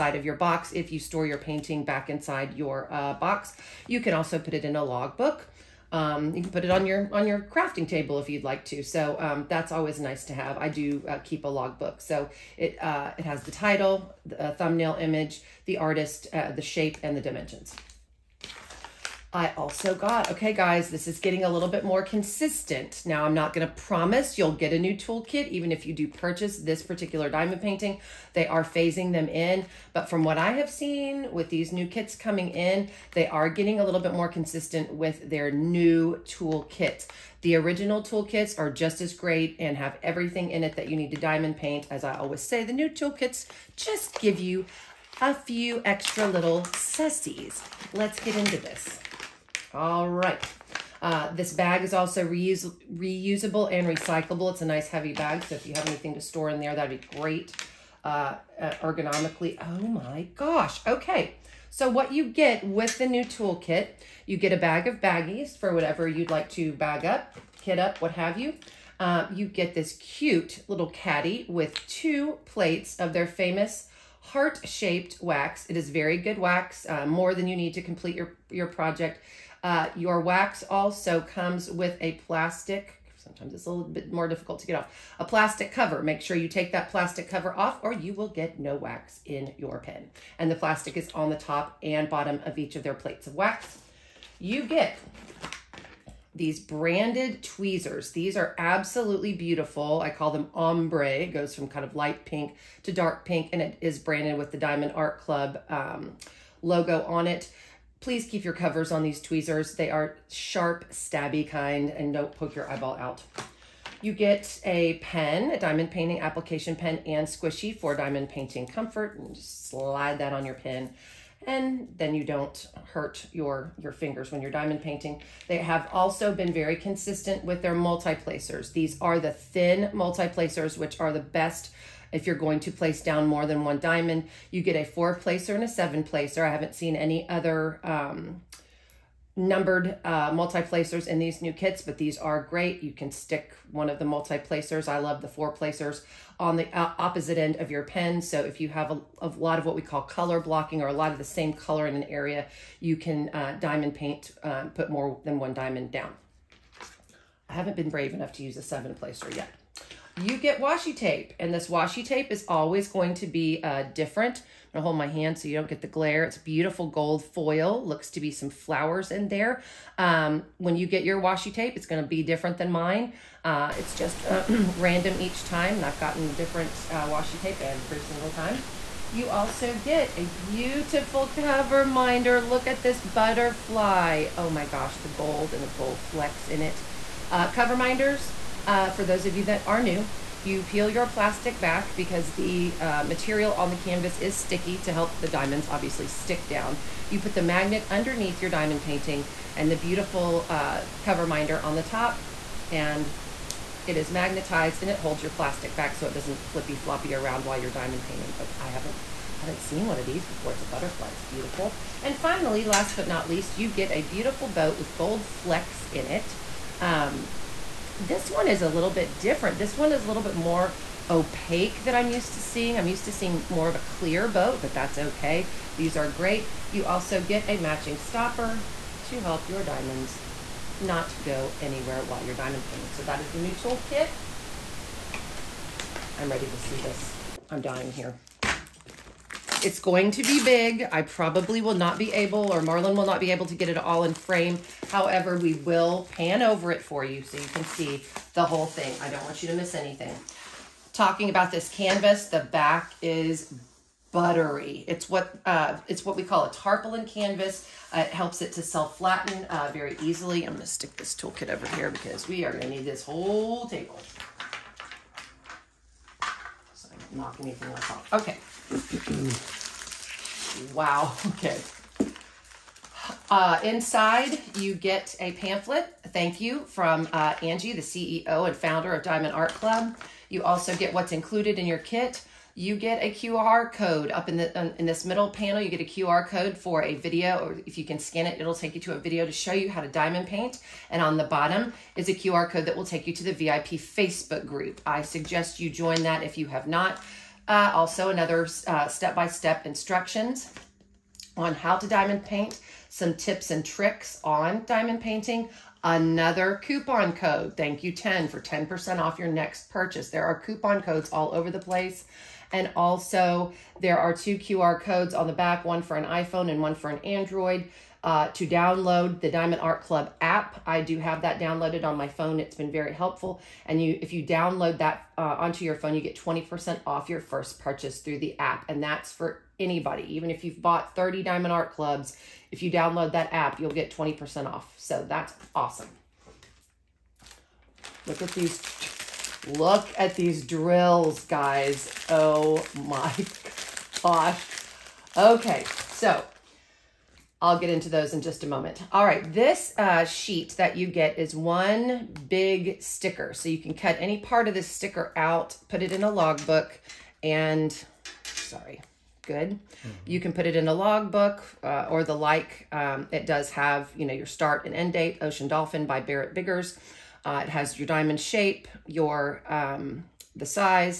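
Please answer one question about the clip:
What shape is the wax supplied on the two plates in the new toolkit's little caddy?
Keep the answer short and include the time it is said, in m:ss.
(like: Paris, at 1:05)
Heart-shaped, at 1:14.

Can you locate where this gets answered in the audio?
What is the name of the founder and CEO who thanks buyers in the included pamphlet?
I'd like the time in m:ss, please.
4:37.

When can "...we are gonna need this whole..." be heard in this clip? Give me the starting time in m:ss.
4:22.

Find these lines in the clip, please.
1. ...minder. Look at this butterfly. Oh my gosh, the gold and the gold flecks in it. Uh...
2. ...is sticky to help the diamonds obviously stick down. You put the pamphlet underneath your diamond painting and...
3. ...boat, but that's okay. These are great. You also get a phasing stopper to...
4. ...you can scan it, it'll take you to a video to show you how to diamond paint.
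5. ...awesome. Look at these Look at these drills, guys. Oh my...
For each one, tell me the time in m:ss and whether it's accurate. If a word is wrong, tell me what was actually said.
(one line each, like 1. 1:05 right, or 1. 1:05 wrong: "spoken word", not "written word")
1. 3:01 right
2. 3:14 wrong: "magnet", not "pamphlet"
3. 3:44 wrong: "matching", not "phasing"
4. 4:47 right
5. 5:35 right.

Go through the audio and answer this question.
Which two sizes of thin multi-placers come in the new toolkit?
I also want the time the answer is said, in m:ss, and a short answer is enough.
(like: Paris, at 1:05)
4 and 7, at 2:14.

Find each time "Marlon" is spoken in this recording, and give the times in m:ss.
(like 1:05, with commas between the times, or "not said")
4:02.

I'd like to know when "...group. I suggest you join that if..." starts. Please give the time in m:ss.
4:54.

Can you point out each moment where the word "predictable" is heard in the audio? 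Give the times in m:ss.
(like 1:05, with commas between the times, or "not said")
not said.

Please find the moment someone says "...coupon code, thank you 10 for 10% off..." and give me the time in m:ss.
5:06.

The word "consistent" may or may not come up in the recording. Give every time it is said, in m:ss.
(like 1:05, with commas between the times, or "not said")
0:22, 0:34, 2:06.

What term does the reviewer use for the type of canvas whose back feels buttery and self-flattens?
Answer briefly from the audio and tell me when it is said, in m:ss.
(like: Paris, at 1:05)
Tarpaulin canvas, at 4:16.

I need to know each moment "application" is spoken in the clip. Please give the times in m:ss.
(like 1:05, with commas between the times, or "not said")
1:56.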